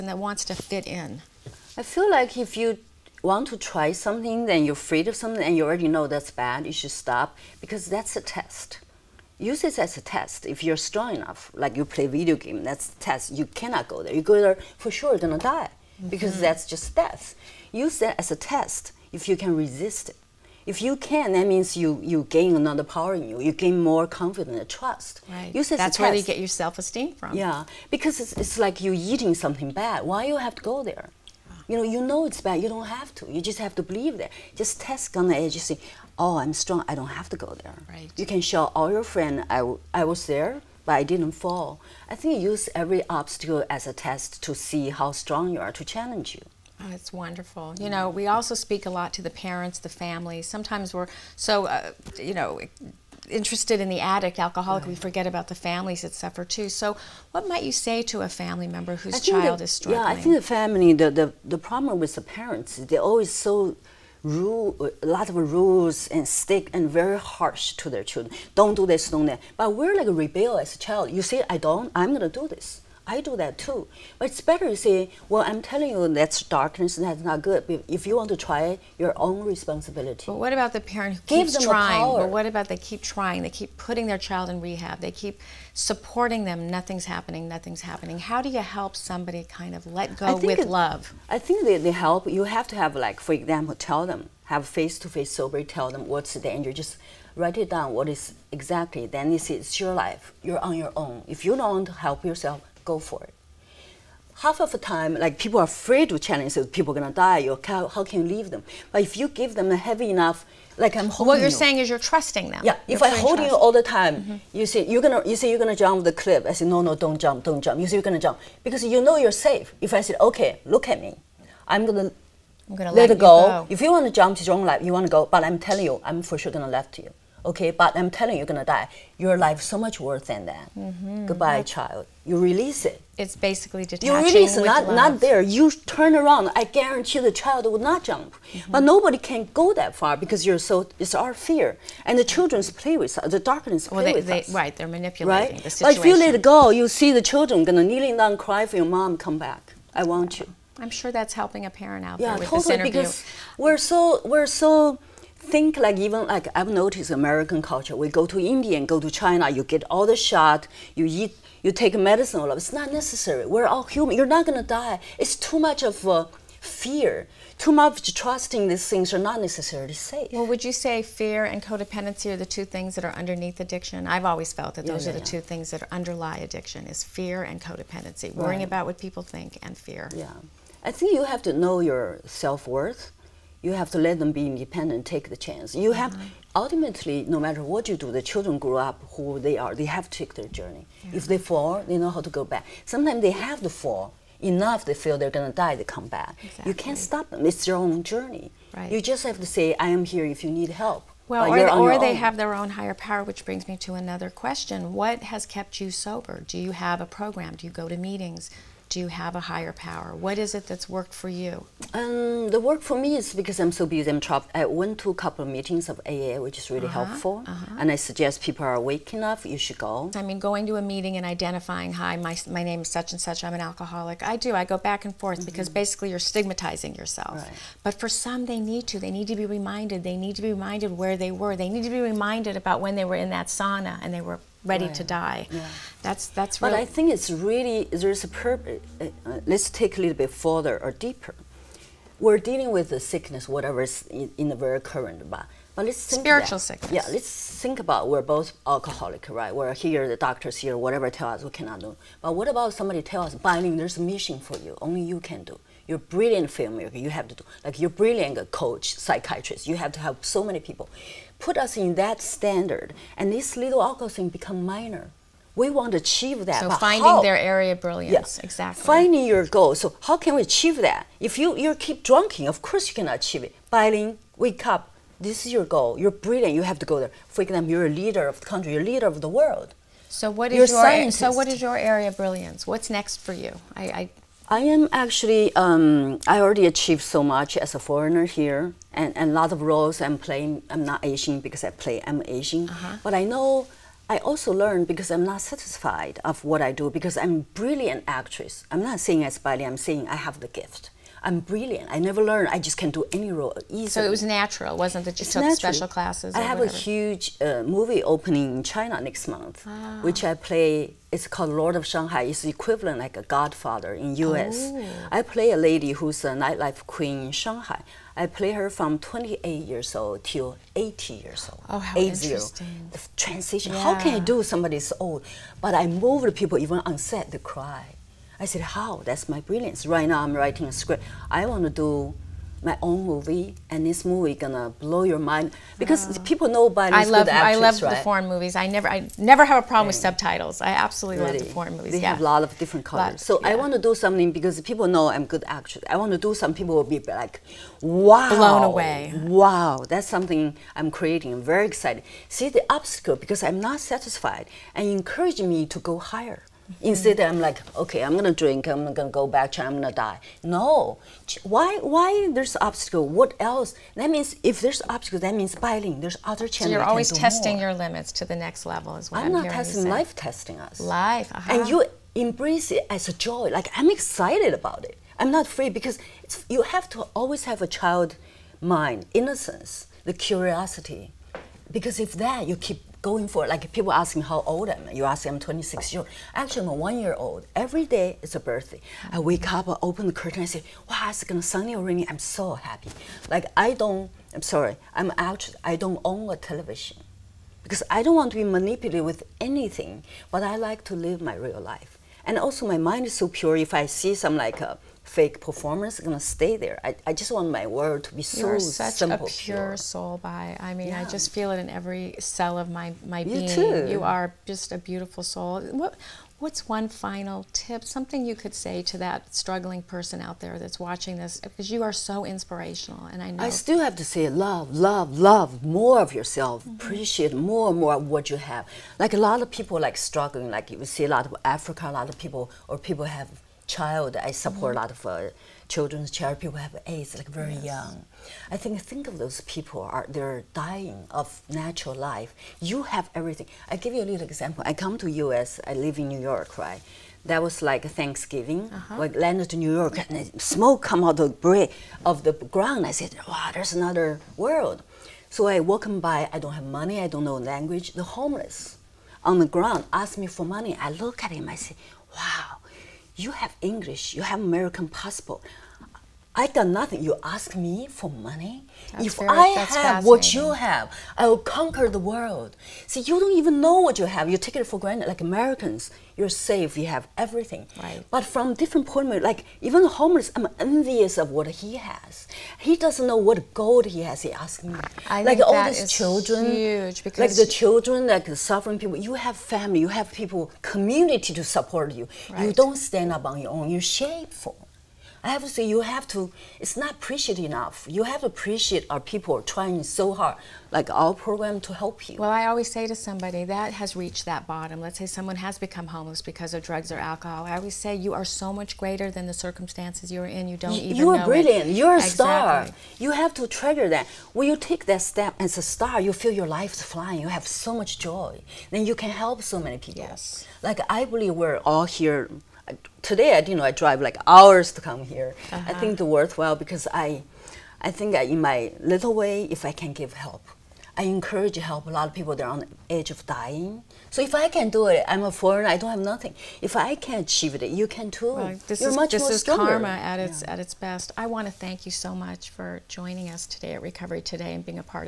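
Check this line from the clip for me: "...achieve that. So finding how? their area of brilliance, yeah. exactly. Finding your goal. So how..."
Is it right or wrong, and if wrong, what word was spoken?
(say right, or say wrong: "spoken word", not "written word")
right.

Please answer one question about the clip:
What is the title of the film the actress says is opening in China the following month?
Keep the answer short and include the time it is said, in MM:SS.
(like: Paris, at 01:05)
Lord of Shanghai, at 05:11.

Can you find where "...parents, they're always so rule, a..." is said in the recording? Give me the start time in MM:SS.
01:02.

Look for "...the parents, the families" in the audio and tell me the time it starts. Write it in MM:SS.
00:49.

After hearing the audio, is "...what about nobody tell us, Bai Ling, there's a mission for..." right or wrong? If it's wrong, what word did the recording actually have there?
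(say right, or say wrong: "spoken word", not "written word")
wrong: "somebody", not "nobody".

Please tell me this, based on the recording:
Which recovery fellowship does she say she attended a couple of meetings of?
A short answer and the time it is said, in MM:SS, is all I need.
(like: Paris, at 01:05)
AA, at 03:36.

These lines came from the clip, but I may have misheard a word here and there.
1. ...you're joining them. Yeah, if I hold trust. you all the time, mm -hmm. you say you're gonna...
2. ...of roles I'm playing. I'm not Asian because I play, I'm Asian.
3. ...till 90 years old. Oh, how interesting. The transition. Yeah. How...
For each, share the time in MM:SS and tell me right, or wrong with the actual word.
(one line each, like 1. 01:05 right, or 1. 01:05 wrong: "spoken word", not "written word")
1. 01:51 wrong: "trusting", not "joining"
2. 04:49 right
3. 05:20 wrong: "80", not "90".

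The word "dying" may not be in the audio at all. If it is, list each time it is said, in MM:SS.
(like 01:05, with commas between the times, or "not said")
07:20, 08:53.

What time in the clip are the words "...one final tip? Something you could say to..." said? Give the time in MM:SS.
06:56.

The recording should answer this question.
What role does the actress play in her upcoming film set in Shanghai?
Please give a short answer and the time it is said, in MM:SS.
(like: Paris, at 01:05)
Nightlife queen, at 05:16.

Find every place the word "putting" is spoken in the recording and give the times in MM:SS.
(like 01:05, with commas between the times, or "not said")
01:23.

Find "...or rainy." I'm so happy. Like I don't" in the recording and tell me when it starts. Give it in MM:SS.
06:31.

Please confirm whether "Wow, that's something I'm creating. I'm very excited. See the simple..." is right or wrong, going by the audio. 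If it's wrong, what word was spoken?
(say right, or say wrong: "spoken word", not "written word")
wrong: "obstacle", not "simple".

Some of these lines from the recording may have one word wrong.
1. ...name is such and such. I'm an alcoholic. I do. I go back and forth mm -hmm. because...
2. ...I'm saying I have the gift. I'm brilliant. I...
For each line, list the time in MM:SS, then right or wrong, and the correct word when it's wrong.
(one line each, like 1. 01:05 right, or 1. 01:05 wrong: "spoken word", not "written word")
1. 03:42 right
2. 04:59 right.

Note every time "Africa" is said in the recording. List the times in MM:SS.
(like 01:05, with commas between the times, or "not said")
07:11.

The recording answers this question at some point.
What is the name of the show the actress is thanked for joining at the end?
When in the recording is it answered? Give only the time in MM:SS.
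09:03.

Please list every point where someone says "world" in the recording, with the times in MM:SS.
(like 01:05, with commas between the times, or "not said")
04:39, 06:47, 07:34, 07:51.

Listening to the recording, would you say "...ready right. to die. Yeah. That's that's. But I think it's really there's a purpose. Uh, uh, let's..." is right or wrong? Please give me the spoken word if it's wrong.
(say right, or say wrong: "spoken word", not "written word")
right.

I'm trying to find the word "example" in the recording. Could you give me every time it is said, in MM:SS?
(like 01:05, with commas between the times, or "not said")
01:33, 04:37, 07:24.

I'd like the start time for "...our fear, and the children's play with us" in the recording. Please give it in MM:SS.
02:21.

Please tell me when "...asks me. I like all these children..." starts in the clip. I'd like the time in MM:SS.
08:04.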